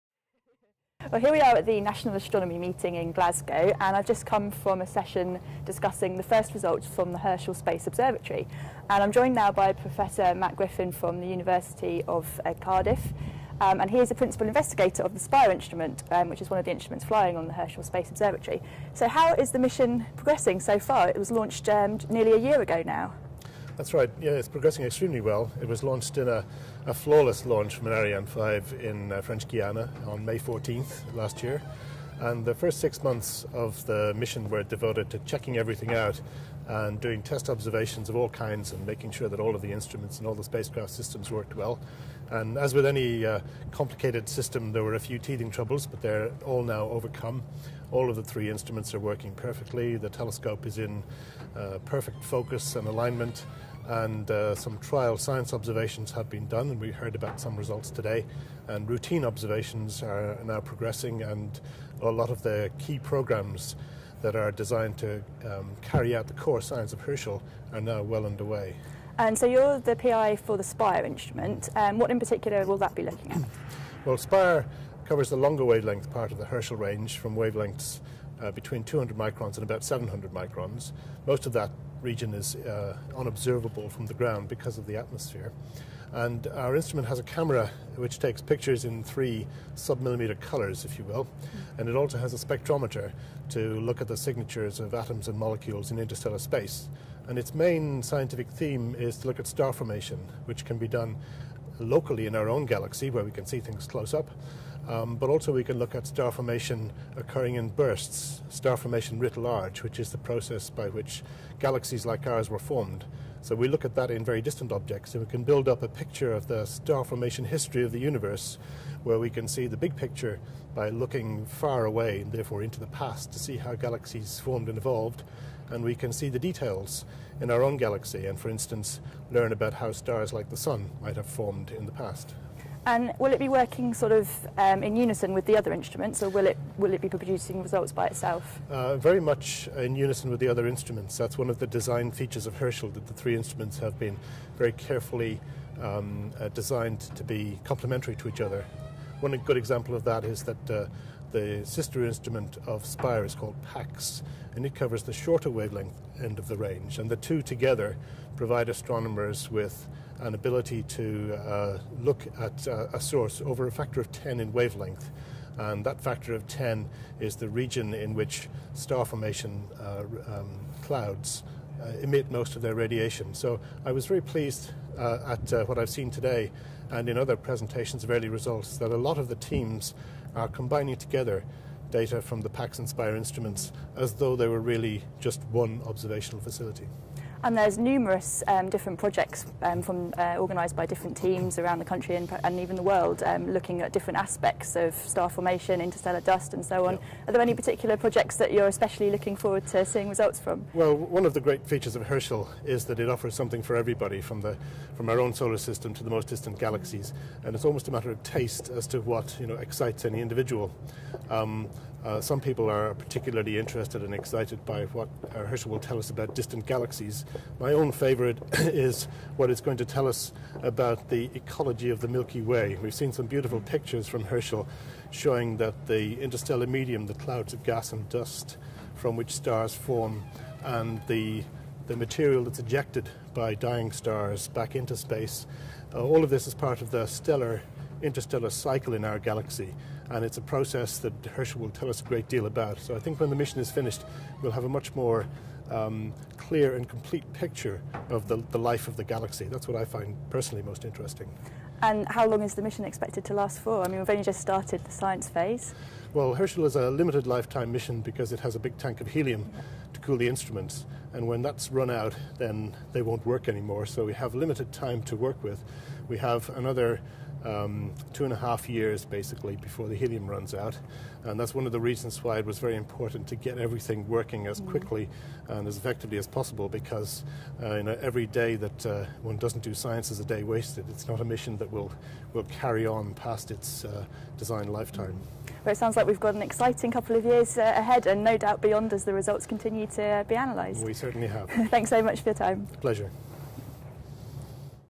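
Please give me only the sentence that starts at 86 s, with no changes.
And our instrument has a camera which takes pictures in three submillimeter colors, if you will.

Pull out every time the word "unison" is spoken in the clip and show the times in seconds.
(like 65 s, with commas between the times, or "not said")
134 s, 139 s.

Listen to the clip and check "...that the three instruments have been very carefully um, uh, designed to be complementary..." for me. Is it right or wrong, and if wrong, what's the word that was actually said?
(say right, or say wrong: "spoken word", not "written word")
right.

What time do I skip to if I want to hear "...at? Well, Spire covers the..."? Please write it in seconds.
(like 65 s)
73 s.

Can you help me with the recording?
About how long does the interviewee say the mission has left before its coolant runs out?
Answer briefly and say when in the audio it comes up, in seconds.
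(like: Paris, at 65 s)
2.5 years, at 268 s.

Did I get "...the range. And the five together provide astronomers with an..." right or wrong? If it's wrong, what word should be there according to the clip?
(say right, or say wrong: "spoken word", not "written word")
wrong: "two", not "five".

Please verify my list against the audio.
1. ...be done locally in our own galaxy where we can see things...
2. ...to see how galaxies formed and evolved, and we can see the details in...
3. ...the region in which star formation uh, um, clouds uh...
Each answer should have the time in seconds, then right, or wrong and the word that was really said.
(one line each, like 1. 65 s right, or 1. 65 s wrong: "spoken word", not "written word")
1. 100 s right
2. 123 s right
3. 167 s right.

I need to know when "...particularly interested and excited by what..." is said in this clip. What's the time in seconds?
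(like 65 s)
212 s.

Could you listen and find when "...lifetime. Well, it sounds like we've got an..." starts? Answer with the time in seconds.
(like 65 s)
284 s.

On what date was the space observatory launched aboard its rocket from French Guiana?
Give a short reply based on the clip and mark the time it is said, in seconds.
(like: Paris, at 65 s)
May 14th, at 30 s.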